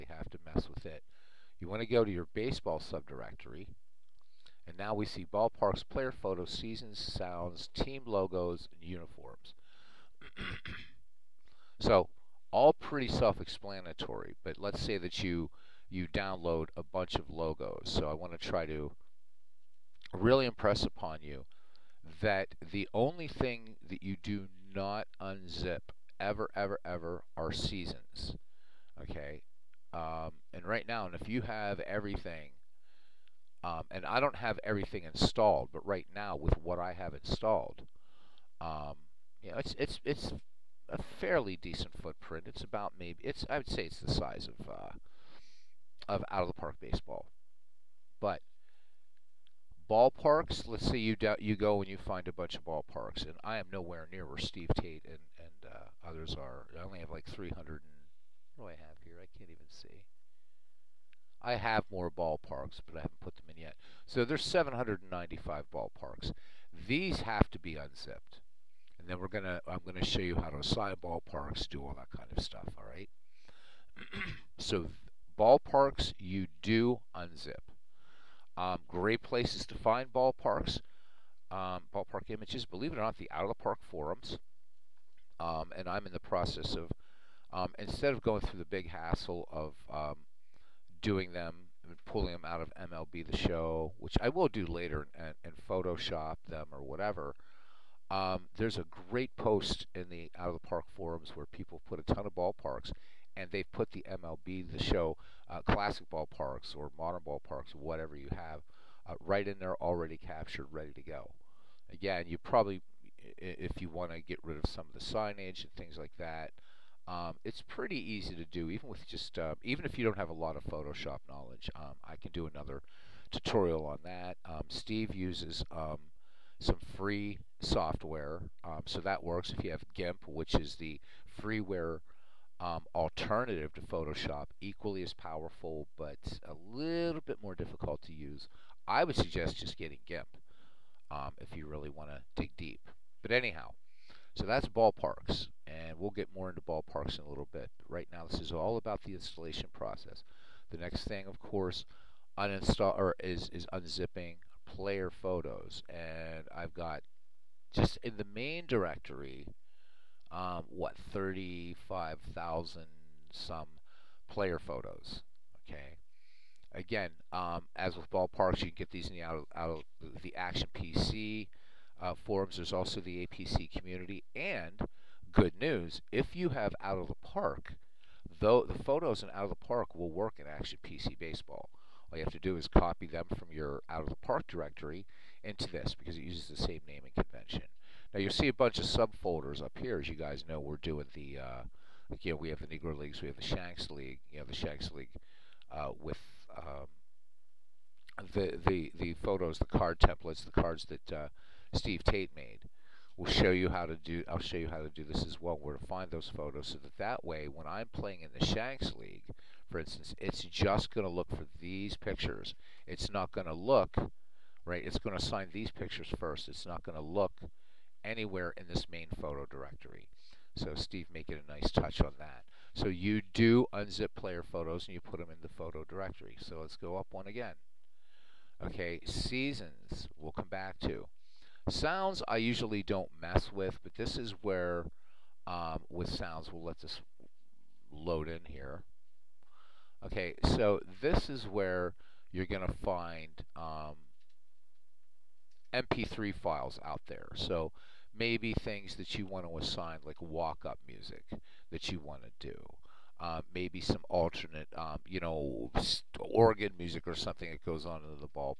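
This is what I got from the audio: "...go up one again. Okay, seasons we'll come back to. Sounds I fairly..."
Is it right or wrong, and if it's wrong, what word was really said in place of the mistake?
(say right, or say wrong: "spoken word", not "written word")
wrong: "usually", not "fairly".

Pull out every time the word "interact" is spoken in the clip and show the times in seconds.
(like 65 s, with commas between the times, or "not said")
not said.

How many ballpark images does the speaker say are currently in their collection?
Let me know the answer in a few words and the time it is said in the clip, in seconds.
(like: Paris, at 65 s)
795, at 64 s.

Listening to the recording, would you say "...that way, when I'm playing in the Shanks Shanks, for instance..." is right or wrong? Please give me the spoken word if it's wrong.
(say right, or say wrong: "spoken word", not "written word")
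wrong: "League", not "Shanks".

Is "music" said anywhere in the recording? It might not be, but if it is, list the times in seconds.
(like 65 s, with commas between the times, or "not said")
250 s, 256 s.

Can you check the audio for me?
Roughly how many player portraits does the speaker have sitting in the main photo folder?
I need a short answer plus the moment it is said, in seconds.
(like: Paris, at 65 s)
35,000, at 161 s.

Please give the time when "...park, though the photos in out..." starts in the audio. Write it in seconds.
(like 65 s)
177 s.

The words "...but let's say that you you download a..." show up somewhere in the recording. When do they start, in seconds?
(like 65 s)
14 s.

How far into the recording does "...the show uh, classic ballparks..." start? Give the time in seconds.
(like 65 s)
104 s.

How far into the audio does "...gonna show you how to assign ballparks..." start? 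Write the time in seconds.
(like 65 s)
69 s.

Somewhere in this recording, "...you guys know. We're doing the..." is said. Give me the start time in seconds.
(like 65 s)
190 s.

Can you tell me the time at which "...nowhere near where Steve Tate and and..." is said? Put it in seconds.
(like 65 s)
53 s.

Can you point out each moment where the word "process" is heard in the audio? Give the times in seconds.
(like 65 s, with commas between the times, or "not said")
86 s, 149 s.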